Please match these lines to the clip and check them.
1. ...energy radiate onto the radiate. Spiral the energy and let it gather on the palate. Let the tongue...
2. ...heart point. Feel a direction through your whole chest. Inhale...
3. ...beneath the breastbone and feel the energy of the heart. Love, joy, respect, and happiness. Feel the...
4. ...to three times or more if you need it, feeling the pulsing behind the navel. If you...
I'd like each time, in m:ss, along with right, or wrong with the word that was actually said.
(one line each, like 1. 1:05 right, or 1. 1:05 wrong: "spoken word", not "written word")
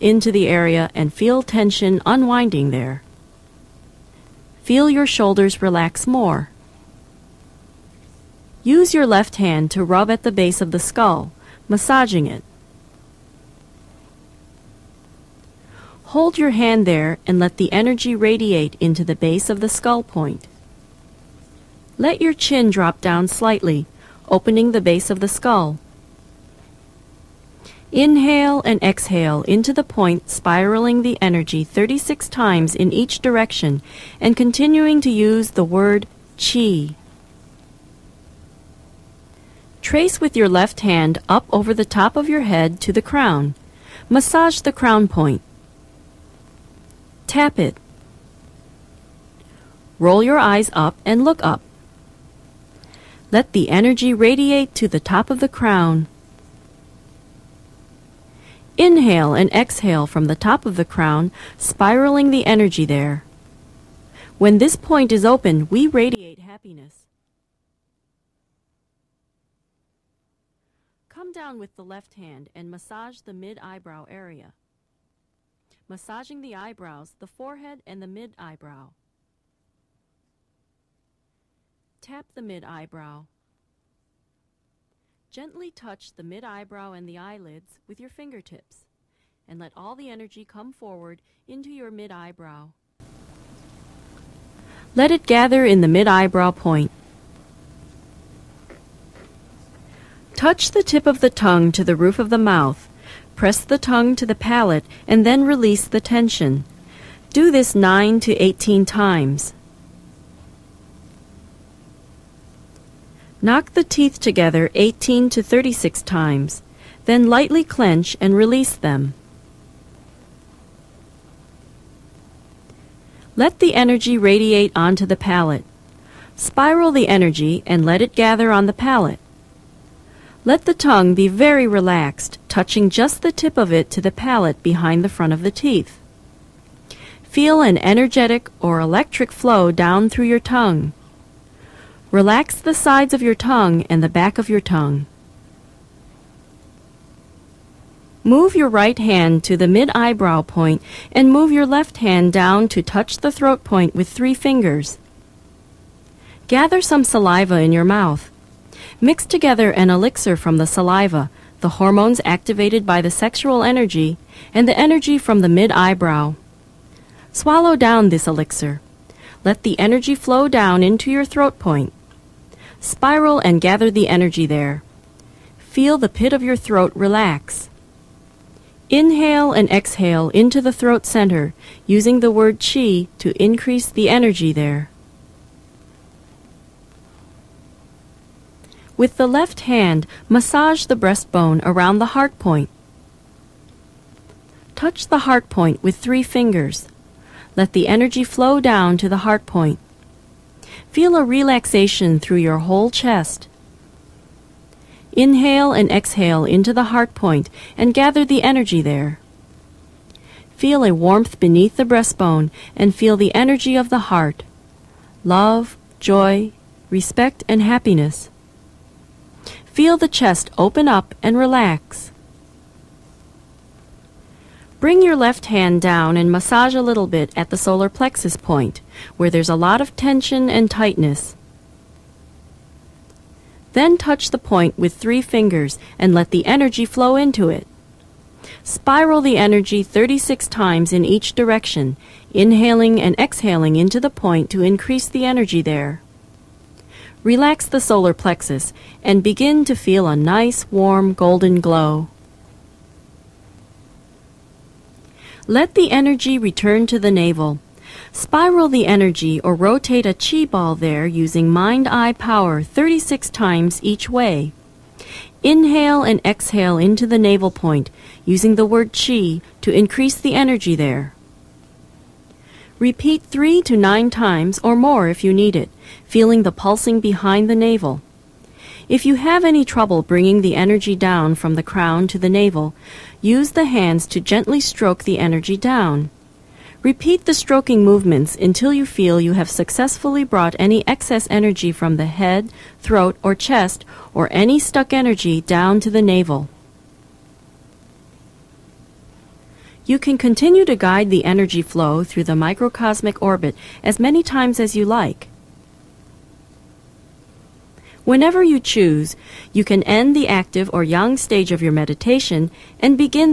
1. 2:03 wrong: "palate", not "radiate"
2. 3:19 wrong: "relaxation", not "direction"
3. 3:31 right
4. 4:33 wrong: "nine", not "three".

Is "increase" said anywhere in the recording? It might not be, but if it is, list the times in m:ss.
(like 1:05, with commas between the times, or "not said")
3:03, 4:04, 4:29.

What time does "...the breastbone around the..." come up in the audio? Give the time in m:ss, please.
3:10.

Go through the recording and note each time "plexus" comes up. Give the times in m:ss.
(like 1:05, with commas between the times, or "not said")
3:47, 4:08.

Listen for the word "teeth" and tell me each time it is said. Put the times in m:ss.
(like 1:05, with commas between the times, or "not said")
1:53, 2:15.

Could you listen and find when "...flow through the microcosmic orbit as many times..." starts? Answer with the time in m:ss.
5:01.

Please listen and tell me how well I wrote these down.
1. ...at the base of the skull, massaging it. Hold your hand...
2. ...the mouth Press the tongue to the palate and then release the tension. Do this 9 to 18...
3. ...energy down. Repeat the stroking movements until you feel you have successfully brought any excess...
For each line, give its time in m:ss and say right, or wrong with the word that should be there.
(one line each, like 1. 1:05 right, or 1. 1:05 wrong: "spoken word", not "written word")
1. 0:10 right
2. 1:42 right
3. 4:45 right.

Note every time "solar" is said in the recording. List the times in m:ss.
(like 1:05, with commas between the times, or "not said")
3:47, 4:07.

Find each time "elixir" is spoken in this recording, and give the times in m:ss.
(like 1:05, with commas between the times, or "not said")
2:39, 2:48.